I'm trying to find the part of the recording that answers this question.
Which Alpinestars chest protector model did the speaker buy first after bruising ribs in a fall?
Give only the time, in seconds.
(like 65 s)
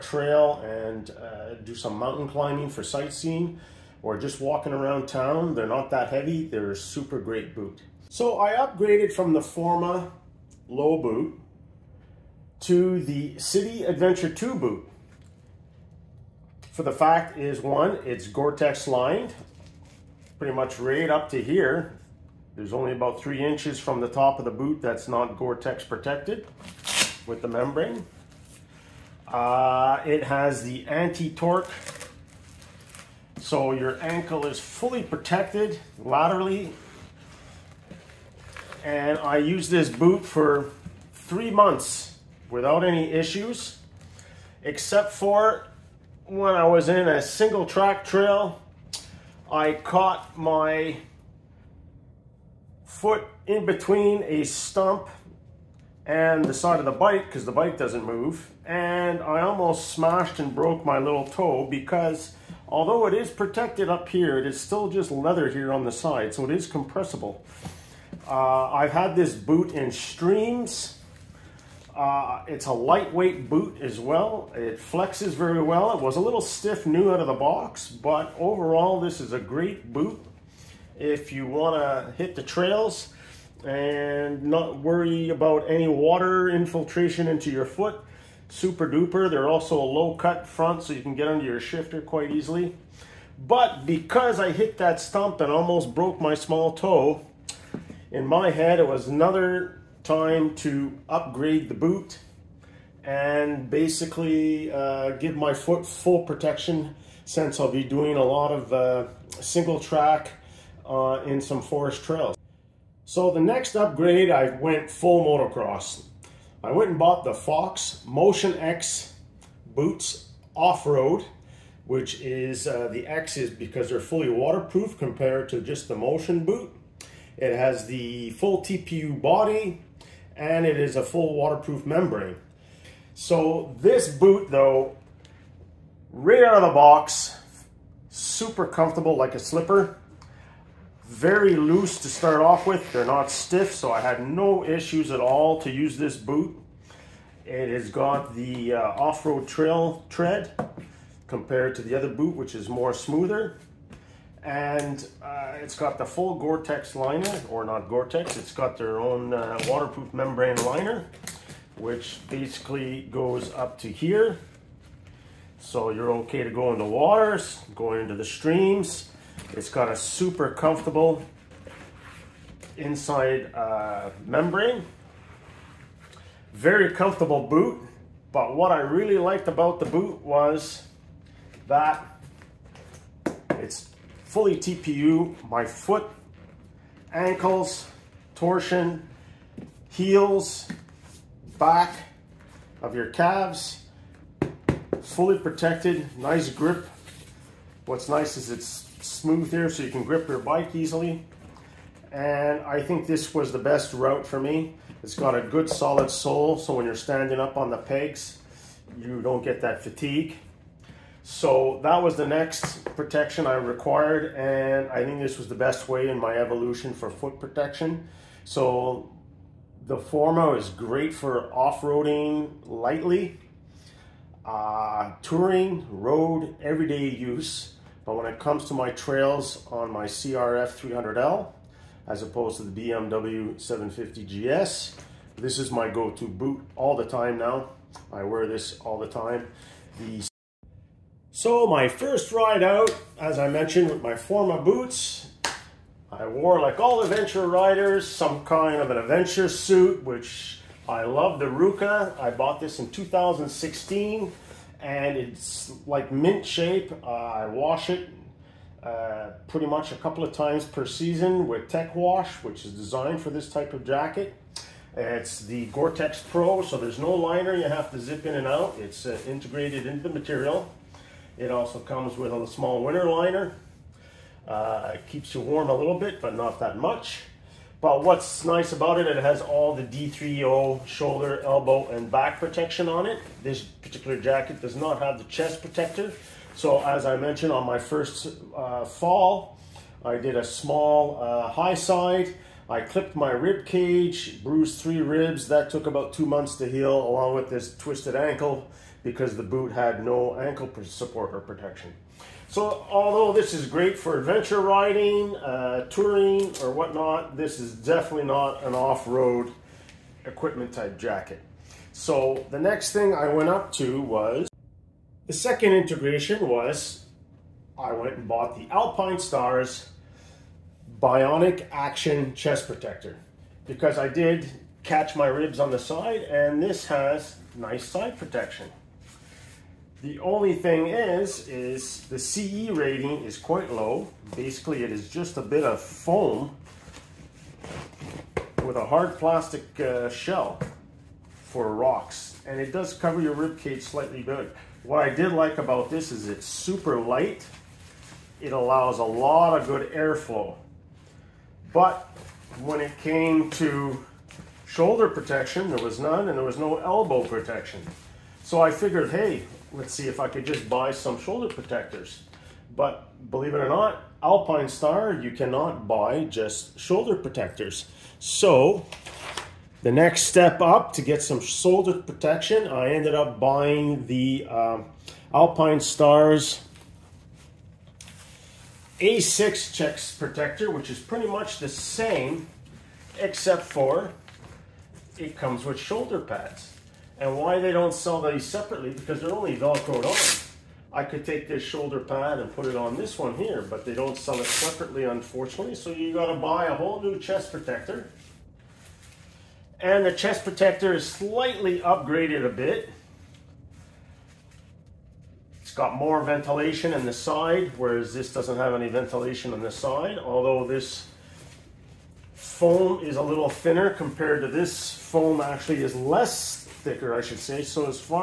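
321 s.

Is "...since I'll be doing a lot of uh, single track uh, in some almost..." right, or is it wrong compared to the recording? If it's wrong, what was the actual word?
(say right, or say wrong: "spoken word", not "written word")
wrong: "forest", not "almost".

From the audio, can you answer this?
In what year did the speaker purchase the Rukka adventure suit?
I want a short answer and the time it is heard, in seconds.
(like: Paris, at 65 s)
2016, at 252 s.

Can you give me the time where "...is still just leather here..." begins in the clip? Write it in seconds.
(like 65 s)
64 s.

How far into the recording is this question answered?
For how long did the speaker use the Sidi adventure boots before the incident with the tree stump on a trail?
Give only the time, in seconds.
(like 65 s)
41 s.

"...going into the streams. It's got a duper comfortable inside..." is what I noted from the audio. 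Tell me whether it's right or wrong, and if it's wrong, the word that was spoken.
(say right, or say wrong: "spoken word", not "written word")
wrong: "super", not "duper".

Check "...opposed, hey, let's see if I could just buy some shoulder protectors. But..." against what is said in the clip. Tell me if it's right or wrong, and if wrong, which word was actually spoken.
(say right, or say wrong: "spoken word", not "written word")
wrong: "figured", not "opposed".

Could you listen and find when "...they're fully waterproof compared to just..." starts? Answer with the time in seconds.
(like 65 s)
123 s.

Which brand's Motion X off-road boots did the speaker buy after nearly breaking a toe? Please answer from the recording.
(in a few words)
Fox.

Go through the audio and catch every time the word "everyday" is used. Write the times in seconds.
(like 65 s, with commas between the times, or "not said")
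226 s.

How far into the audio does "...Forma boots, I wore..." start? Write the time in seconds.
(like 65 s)
244 s.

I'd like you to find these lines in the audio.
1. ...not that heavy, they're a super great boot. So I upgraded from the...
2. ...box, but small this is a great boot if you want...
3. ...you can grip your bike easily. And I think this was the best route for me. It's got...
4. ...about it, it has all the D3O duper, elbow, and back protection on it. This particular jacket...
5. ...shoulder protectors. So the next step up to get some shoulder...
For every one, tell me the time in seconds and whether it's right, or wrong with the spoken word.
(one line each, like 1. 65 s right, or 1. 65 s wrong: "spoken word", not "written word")
1. 5 s right
2. 77 s wrong: "overall", not "small"
3. 199 s right
4. 278 s wrong: "shoulder", not "duper"
5. 366 s right.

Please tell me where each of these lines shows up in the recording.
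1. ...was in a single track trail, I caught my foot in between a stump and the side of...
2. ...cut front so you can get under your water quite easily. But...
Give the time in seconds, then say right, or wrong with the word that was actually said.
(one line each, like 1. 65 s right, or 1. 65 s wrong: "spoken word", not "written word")
1. 46 s right
2. 90 s wrong: "shifter", not "water".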